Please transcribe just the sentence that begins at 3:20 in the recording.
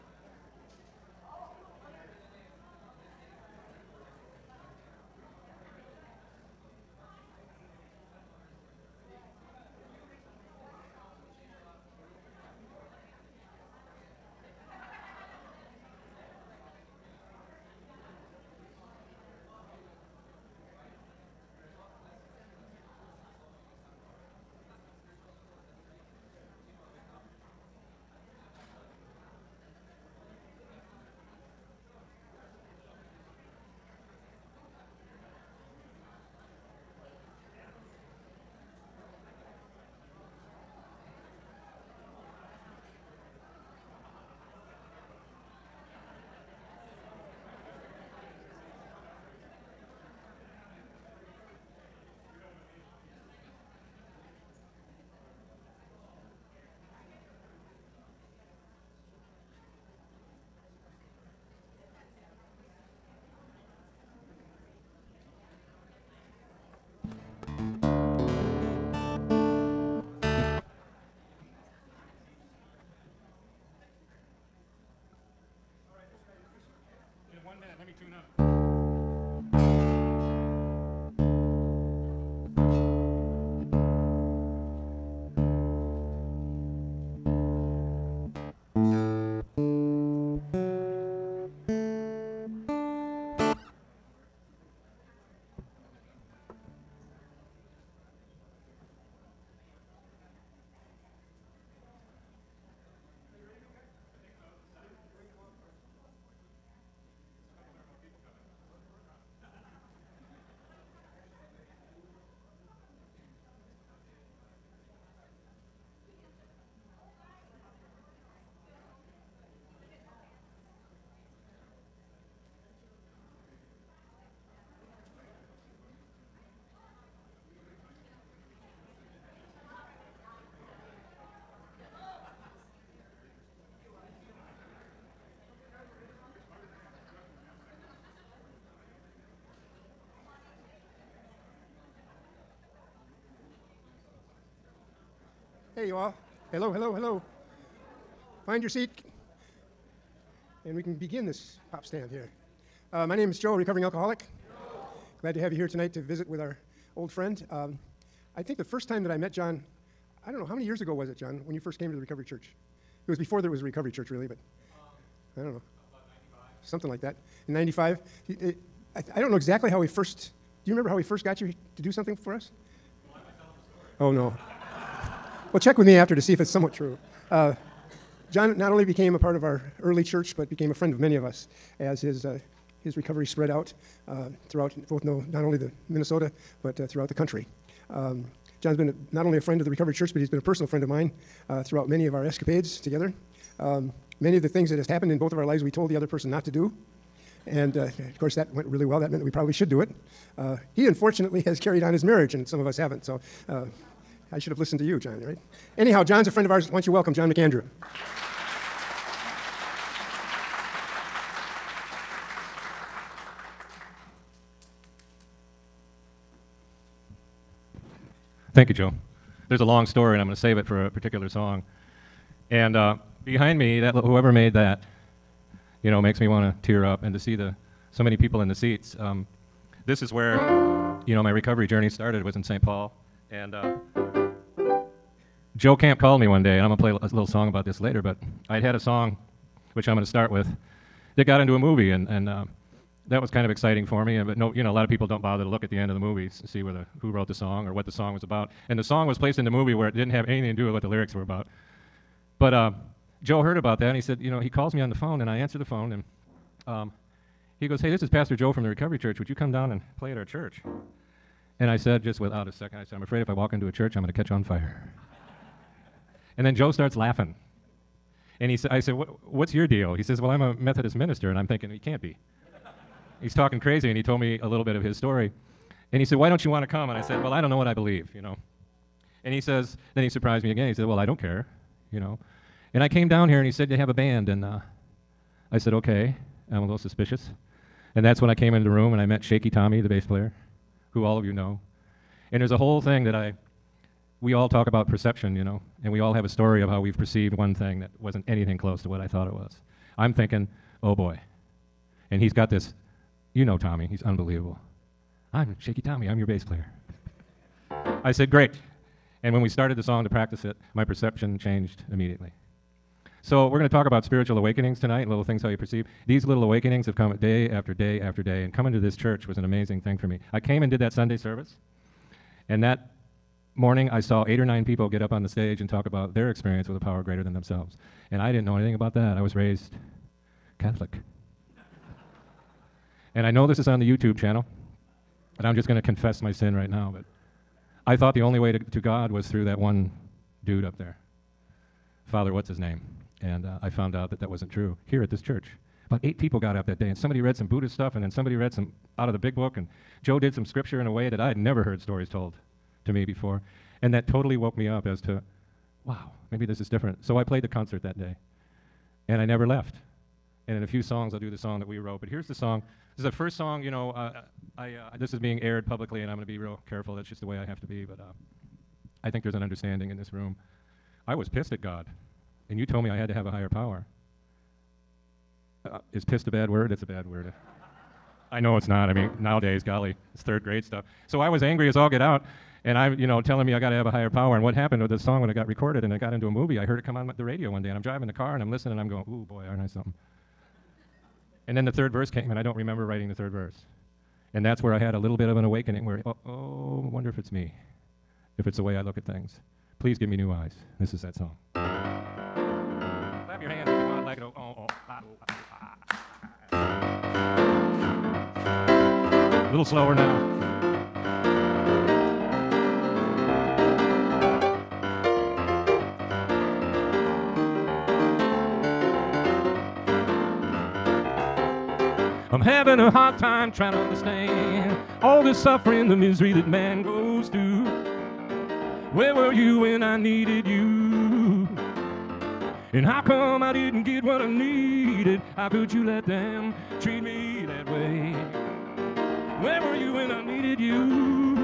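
Uh, he unfortunately has carried on his marriage, and some of us haven't.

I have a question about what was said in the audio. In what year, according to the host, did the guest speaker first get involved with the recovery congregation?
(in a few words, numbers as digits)
1995.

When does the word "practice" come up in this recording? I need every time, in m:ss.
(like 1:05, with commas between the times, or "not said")
5:10.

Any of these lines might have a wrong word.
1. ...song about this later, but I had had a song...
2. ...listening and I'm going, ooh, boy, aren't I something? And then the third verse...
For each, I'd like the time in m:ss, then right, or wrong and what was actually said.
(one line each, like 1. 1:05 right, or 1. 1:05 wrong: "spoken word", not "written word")
1. 3:57 right
2. 6:28 right.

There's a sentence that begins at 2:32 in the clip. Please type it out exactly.
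Uh, my name is Joe, a recovering alcoholic.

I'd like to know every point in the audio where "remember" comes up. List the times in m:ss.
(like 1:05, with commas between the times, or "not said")
2:50, 6:32.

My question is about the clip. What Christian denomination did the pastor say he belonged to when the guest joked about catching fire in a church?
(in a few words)
Methodist.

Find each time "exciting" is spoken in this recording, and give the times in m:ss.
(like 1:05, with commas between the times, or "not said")
4:03.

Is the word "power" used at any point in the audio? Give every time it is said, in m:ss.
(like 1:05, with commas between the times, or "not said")
5:26, 6:13, 6:24.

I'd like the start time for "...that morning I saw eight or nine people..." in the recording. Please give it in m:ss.
5:22.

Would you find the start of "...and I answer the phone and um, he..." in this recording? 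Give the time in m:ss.
4:15.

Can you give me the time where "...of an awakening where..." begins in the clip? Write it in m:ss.
6:35.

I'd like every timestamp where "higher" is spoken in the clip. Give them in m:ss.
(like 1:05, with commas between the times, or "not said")
6:13, 6:23.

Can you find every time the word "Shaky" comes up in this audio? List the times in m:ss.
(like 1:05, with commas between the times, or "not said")
4:49, 5:05.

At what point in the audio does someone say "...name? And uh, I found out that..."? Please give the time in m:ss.
5:42.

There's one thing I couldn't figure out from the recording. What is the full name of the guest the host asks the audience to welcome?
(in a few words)
John McAndrew.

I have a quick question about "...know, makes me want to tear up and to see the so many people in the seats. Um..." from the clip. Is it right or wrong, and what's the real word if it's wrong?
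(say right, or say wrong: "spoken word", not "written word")
right.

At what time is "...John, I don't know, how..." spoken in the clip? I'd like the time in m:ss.
2:39.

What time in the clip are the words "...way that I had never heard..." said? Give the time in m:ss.
5:50.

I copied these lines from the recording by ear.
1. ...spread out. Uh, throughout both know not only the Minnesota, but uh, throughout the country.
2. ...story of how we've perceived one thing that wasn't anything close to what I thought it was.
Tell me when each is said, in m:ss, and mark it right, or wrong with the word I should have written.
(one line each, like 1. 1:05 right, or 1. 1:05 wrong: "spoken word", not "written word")
1. 3:03 right
2. 4:56 right.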